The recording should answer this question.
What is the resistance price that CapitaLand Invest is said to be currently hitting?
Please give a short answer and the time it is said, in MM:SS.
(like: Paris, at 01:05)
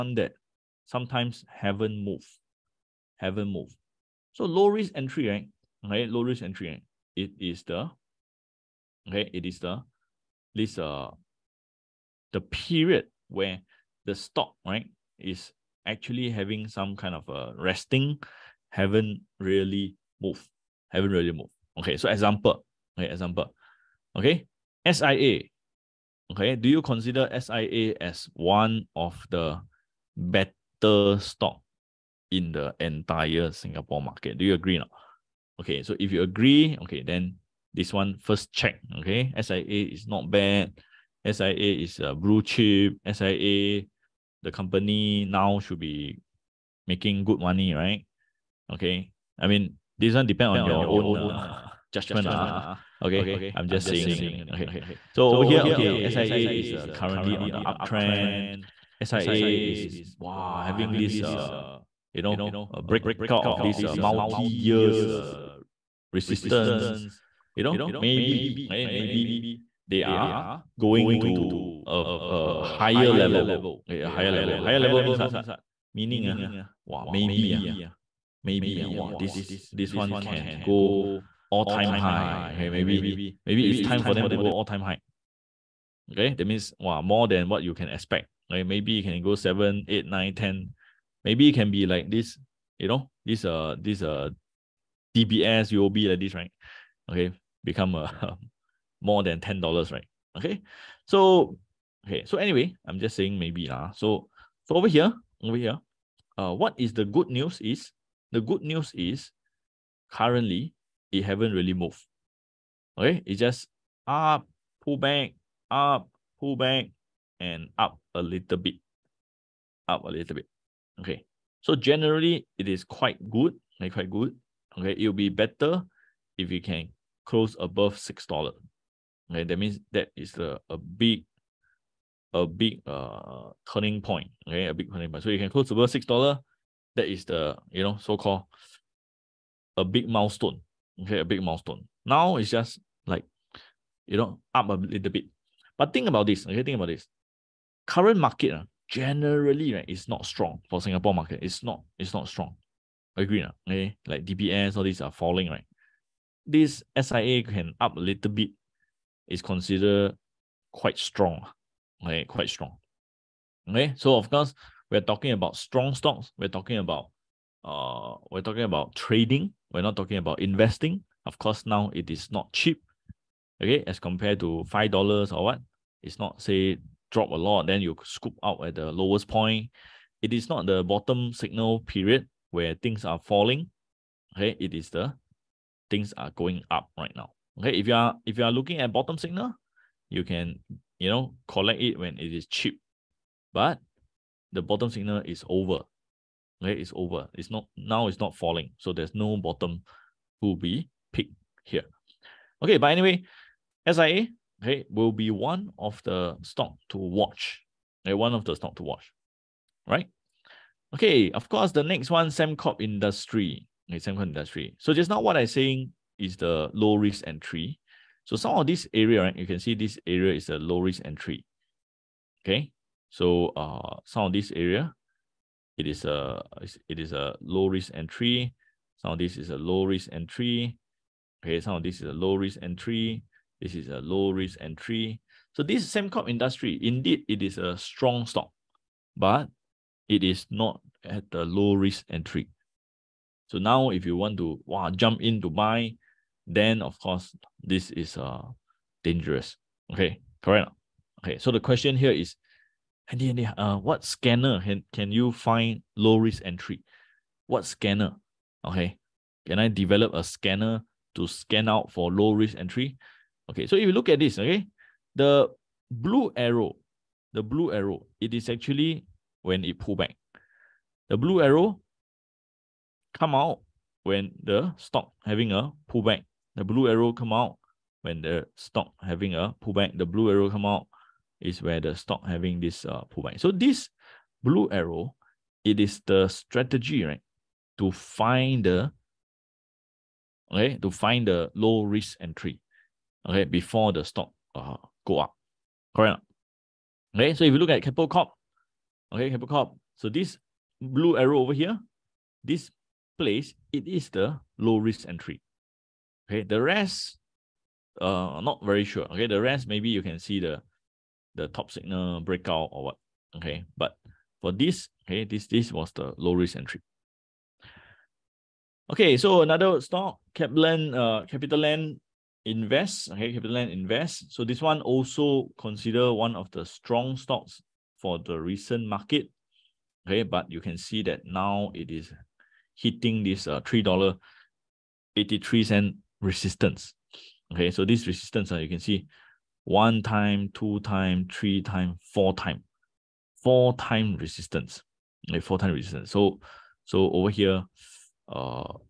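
$3.83, at 05:33.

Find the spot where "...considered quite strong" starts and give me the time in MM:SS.
02:39.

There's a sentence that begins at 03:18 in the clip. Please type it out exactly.
It's not falling, so there's no bottom to be picked here.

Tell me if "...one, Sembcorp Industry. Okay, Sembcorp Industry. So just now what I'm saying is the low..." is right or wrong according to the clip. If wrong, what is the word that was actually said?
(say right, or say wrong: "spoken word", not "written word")
right.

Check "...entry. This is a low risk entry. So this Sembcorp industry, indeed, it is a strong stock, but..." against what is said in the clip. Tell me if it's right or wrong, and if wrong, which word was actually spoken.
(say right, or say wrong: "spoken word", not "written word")
right.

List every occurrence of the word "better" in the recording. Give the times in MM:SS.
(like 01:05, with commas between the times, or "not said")
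00:30, 02:05.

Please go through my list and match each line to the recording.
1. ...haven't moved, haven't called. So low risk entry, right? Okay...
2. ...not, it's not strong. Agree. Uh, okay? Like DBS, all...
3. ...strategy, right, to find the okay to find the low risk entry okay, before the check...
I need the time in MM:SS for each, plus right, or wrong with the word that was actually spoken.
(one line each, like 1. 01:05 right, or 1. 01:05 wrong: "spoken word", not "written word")
1. 00:01 wrong: "moved", not "called"
2. 02:31 right
3. 04:46 wrong: "stock", not "check".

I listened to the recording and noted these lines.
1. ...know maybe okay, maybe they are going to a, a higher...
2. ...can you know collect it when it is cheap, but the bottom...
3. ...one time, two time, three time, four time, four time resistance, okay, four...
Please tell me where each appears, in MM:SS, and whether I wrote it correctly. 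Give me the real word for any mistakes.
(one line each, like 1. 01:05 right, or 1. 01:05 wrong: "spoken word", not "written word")
1. 01:07 right
2. 03:10 right
3. 05:39 right.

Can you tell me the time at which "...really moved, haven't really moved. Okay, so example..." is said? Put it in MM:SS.
00:19.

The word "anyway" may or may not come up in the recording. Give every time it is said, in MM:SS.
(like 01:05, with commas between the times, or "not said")
01:42, 03:22.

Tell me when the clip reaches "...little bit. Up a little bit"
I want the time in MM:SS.
01:58.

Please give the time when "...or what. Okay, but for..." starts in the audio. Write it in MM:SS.
05:12.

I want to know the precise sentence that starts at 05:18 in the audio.
Okay, so another stock, Capland, uh, CapitaLand, Invest, okay, CapitaLand Invest.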